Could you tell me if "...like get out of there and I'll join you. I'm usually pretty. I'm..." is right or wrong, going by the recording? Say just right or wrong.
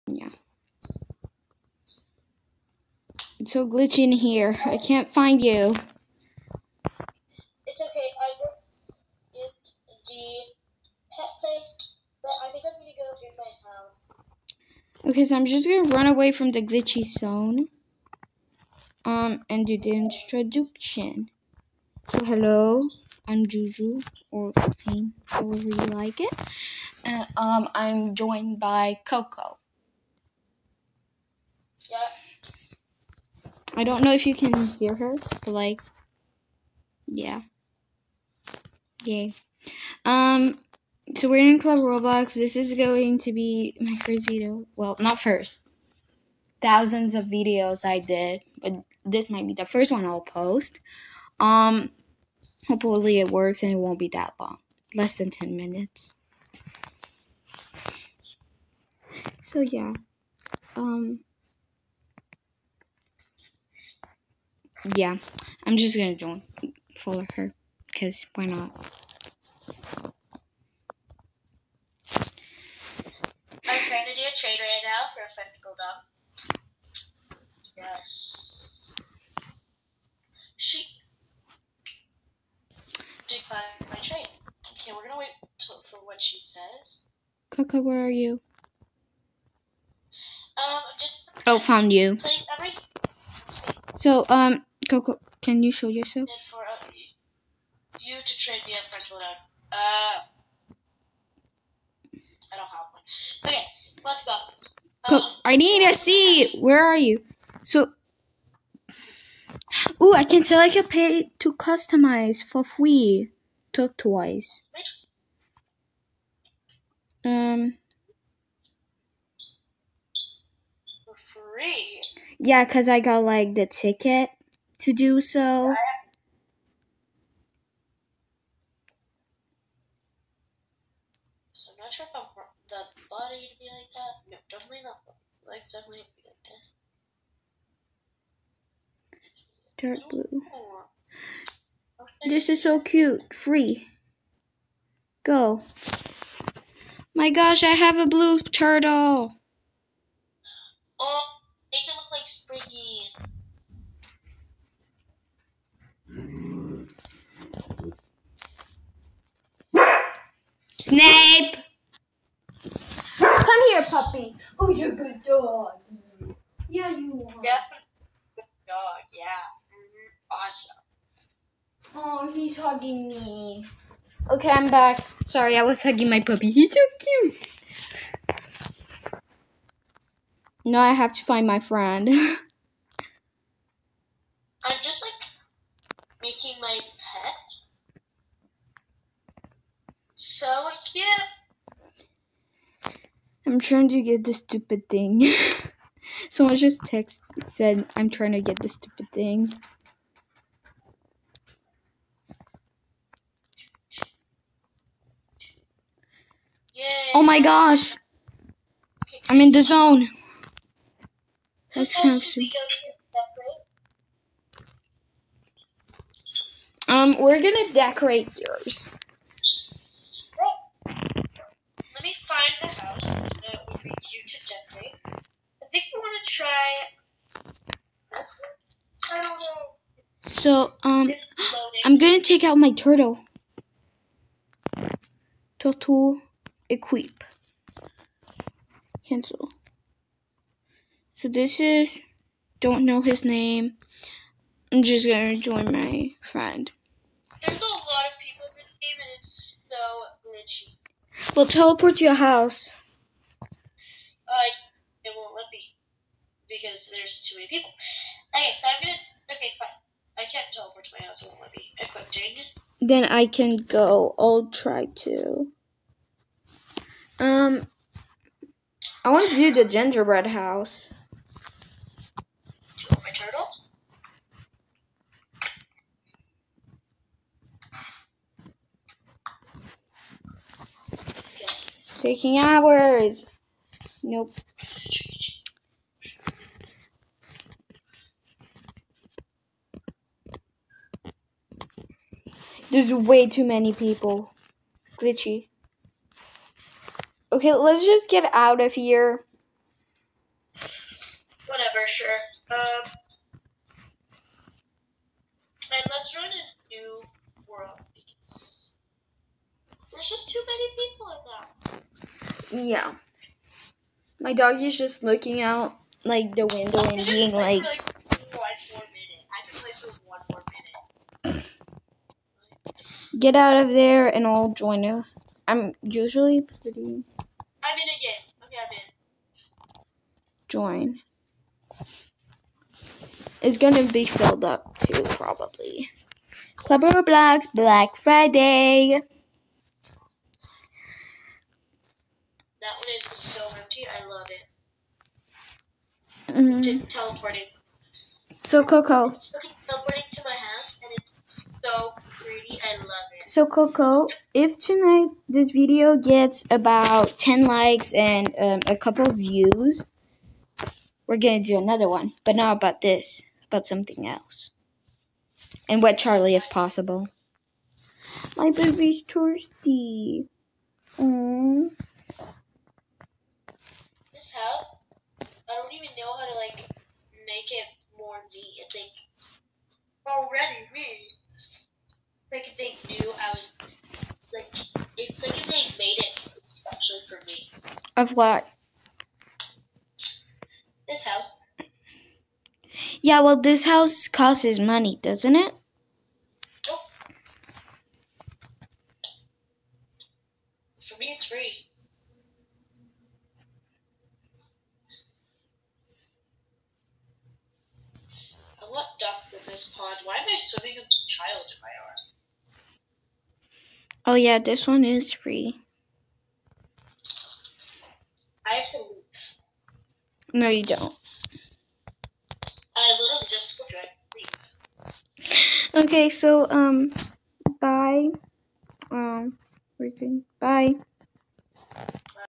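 right.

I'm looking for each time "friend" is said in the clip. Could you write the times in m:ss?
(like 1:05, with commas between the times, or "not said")
3:01, 4:06.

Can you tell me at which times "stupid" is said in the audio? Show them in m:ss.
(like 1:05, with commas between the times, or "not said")
3:14, 3:18, 3:32.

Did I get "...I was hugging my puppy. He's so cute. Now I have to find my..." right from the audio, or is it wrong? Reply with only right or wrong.
right.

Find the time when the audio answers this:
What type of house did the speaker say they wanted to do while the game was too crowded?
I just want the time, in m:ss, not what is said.
4:29.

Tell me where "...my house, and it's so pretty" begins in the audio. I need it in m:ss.
5:50.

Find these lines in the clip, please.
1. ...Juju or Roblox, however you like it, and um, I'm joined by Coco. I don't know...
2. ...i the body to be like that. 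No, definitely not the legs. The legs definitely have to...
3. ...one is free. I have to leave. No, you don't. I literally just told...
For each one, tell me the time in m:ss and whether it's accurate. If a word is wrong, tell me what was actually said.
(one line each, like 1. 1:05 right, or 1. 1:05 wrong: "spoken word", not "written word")
1. 0:23 wrong: "Pain", not "Roblox"
2. 2:12 right
3. 6:54 right.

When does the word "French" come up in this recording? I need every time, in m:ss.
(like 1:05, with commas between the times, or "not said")
1:38.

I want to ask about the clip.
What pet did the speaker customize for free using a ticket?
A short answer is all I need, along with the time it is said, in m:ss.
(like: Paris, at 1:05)
Blue turtle, at 2:28.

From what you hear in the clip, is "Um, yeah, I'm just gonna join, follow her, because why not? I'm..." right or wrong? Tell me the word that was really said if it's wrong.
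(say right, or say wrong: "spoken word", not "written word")
right.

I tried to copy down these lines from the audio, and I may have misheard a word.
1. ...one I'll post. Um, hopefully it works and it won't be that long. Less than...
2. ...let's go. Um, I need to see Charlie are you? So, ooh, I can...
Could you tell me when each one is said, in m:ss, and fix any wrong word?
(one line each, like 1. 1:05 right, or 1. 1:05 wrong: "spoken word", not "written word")
1. 0:49 right
2. 1:44 wrong: "Where", not "Charlie".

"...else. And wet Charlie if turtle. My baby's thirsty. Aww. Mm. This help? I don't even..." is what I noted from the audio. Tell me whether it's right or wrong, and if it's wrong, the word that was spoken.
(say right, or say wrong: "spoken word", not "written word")
wrong: "possible", not "turtle".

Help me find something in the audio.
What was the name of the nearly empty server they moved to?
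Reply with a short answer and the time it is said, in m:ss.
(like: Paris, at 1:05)
Club Roblox Black Friday, at 5:36.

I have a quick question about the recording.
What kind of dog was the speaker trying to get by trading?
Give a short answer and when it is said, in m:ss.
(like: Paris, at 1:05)
Spectacle dog, at 1:15.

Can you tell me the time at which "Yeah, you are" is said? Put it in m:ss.
2:46.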